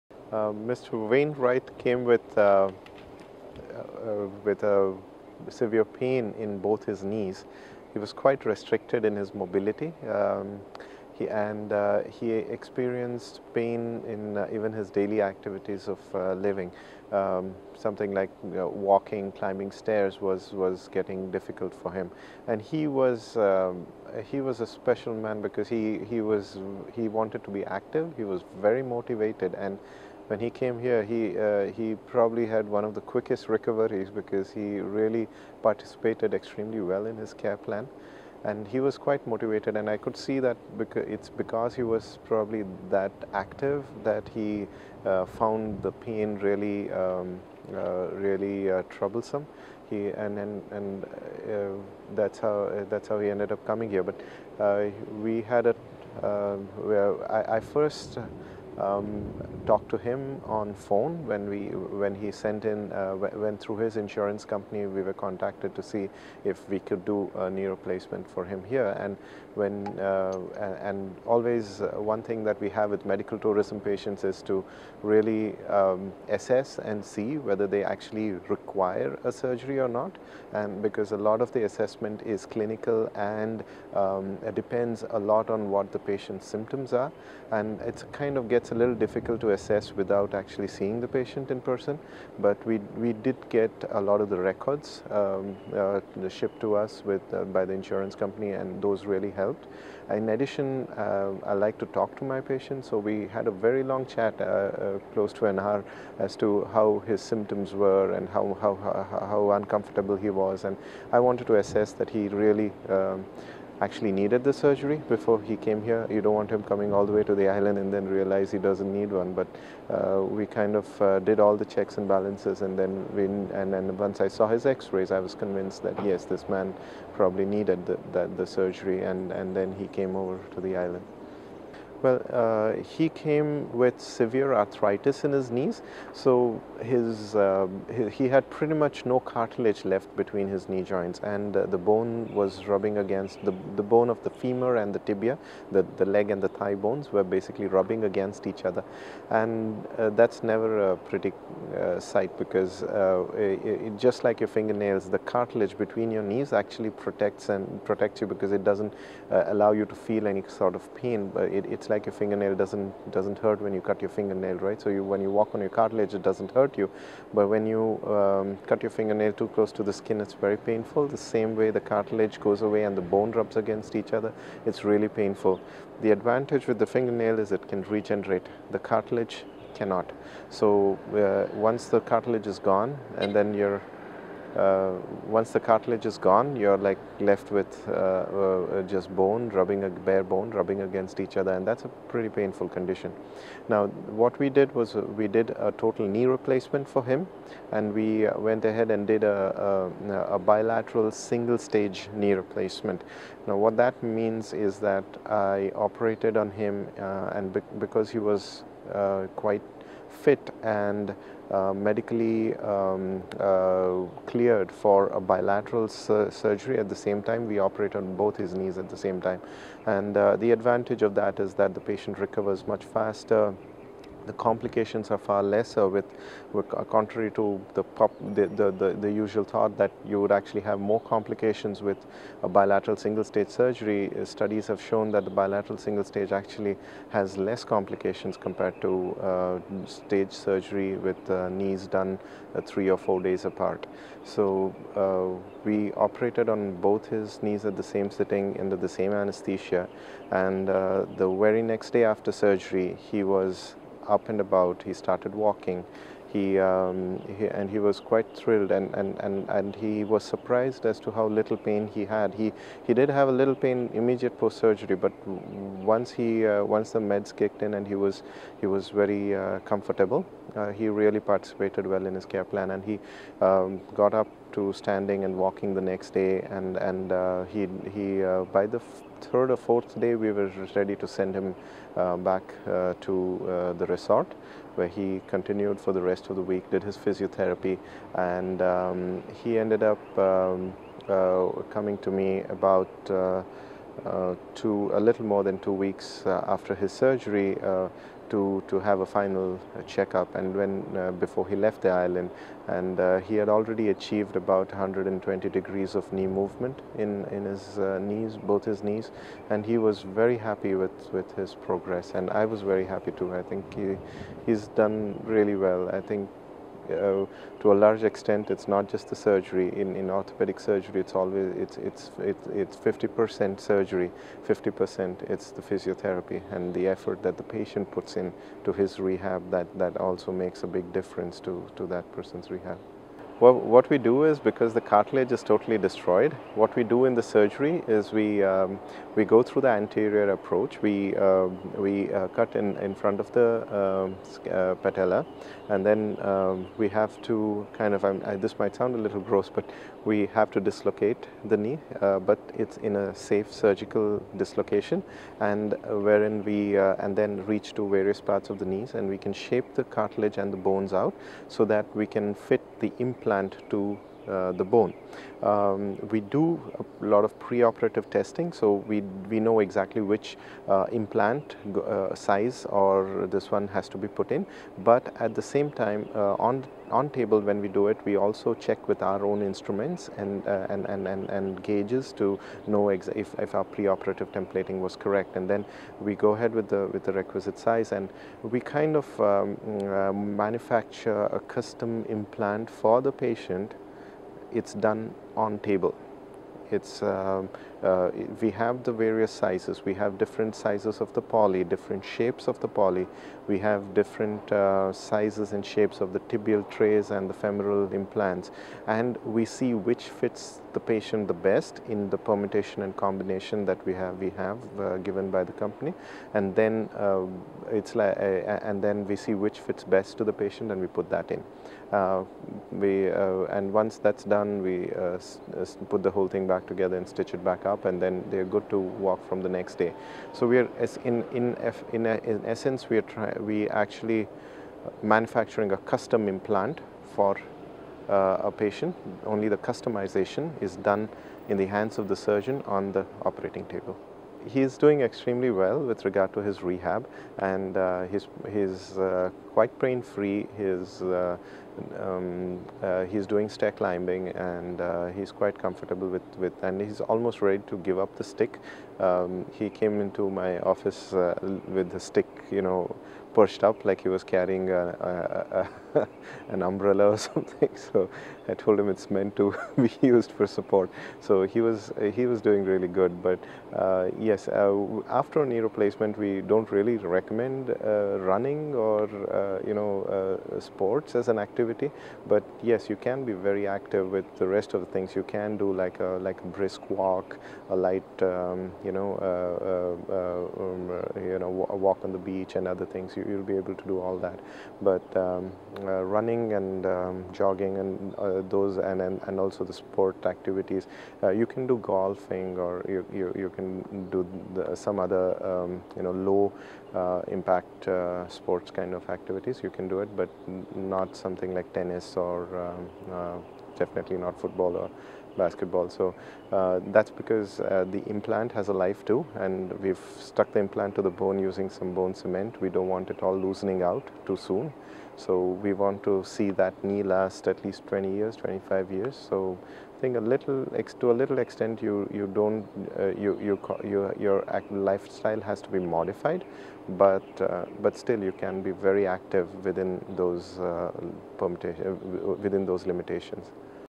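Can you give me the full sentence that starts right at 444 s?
He is doing extremely well with regard to his rehab and uh, his, his uh, quite pain free.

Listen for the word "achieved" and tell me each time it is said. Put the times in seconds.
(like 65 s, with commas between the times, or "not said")
303 s.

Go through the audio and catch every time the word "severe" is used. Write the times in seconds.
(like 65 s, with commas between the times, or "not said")
5 s, 134 s.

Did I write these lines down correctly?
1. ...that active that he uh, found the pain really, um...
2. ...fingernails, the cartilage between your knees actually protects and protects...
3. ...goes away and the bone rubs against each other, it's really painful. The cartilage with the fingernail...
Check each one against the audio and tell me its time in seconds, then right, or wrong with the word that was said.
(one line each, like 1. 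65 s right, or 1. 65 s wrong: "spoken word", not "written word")
1. 42 s right
2. 154 s right
3. 172 s wrong: "advantage", not "cartilage".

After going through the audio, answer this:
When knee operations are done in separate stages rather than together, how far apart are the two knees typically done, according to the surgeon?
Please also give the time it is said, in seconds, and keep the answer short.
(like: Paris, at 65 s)
3 or 4 days, at 242 s.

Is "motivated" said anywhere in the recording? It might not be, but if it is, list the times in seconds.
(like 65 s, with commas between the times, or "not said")
28 s, 39 s.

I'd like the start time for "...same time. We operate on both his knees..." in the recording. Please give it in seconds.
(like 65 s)
216 s.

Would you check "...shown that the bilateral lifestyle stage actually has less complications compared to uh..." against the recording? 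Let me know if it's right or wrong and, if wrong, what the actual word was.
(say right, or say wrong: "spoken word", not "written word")
wrong: "single", not "lifestyle".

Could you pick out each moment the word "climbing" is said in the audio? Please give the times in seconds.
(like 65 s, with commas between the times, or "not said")
19 s, 453 s.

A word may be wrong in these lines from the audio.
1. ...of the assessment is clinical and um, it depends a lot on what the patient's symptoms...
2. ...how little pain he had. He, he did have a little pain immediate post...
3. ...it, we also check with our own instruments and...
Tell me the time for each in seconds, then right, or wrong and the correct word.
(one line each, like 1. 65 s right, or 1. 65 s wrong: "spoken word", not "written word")
1. 81 s right
2. 261 s right
3. 377 s right.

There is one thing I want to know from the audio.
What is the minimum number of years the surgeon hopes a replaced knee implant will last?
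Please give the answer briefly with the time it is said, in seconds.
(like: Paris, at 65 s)
20 years, at 527 s.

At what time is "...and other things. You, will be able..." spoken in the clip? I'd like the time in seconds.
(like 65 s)
492 s.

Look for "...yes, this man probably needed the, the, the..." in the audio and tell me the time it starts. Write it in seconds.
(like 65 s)
126 s.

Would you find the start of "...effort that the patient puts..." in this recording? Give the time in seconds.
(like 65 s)
326 s.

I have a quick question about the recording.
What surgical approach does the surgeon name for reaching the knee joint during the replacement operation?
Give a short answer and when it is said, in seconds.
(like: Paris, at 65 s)
Anterior approach, at 339 s.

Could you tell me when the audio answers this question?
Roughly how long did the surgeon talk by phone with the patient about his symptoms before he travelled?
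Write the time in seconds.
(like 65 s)
105 s.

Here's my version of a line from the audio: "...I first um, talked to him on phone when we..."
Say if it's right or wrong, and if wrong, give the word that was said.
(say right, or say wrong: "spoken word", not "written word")
right.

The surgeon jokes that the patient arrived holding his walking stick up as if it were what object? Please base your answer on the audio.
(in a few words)
Umbrella.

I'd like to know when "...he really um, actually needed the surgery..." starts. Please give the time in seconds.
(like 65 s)
112 s.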